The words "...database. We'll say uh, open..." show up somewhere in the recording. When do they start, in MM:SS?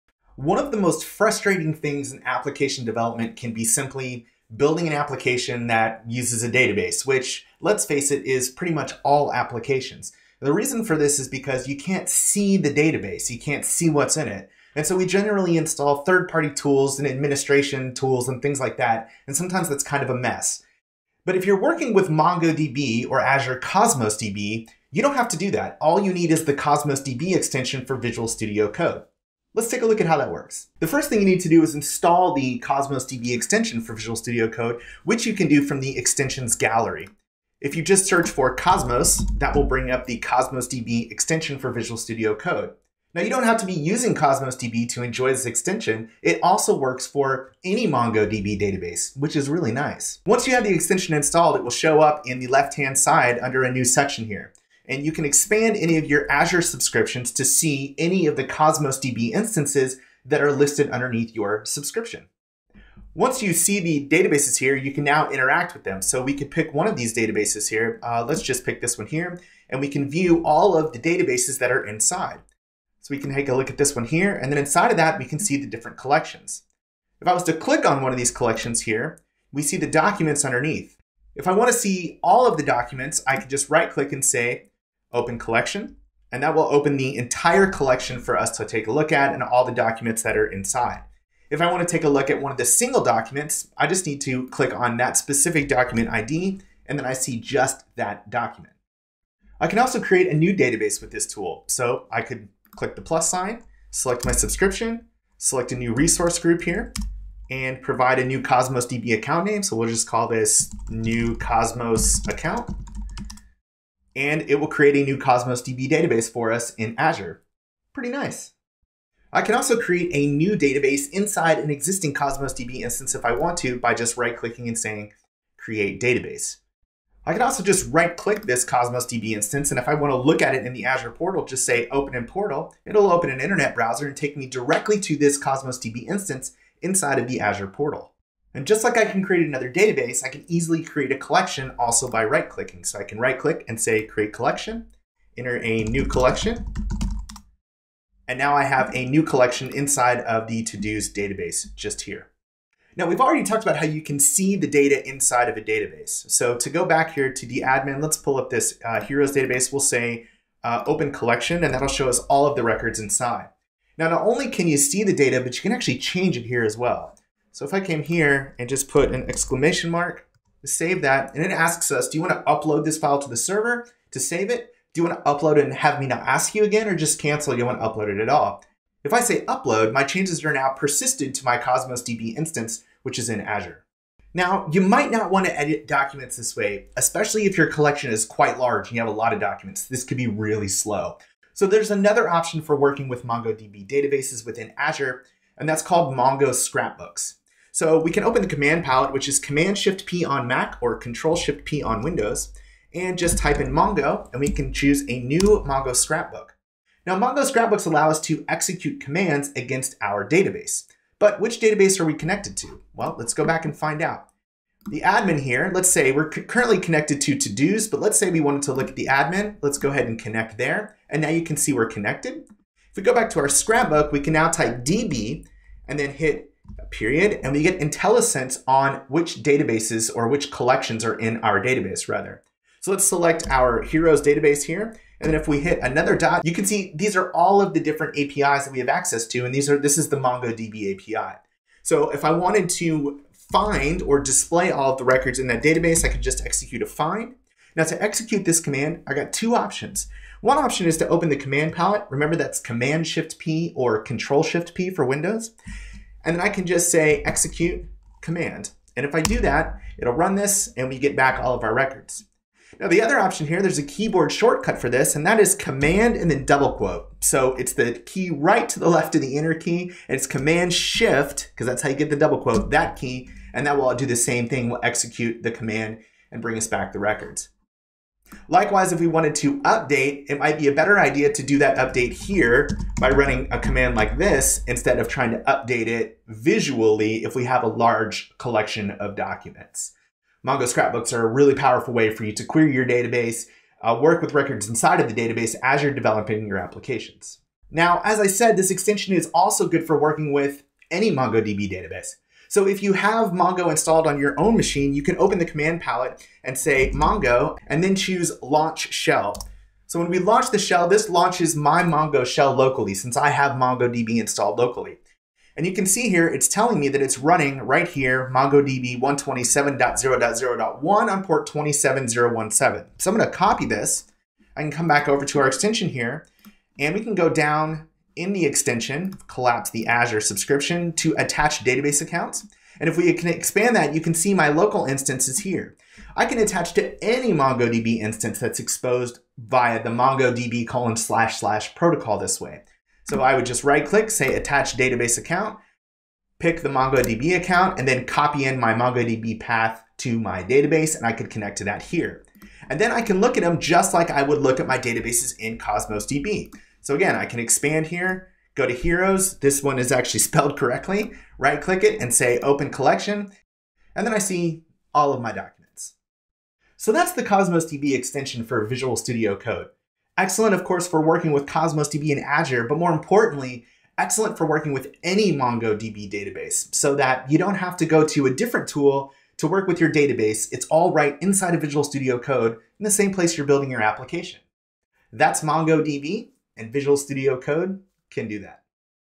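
02:39.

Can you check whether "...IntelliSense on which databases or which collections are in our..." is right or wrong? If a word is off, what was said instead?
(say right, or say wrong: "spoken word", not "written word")
right.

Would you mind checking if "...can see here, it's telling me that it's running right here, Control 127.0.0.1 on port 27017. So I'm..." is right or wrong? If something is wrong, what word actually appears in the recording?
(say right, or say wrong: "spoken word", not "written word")
wrong: "MongoDB", not "Control".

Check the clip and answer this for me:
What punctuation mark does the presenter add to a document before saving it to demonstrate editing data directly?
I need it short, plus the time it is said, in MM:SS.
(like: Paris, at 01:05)
exclamation mark, at 02:49.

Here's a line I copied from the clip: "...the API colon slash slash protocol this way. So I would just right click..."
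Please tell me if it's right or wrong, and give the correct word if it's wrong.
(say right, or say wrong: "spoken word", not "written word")
wrong: "MongoDB", not "API".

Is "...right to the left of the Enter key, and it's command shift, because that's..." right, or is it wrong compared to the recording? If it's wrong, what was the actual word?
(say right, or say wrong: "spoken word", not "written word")
right.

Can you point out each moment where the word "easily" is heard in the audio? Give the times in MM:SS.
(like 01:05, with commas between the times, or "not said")
02:20.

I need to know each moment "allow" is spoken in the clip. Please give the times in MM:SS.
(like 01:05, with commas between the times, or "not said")
03:27.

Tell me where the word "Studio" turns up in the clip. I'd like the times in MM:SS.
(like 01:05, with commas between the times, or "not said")
00:28, 00:34, 00:41, 06:08, 06:21, 06:26.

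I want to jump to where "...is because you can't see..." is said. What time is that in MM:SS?
00:11.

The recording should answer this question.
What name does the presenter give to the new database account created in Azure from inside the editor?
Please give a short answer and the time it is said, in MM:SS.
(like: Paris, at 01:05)
new Cosmos account, at 01:50.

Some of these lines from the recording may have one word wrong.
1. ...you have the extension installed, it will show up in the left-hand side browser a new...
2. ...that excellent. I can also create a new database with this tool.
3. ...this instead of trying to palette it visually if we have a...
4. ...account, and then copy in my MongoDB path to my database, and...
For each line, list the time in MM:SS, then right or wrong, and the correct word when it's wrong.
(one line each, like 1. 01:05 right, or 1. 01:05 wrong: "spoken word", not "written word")
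1. 00:50 wrong: "under", not "browser"
2. 01:37 wrong: "document", not "excellent"
3. 04:44 wrong: "update", not "palette"
4. 05:47 right.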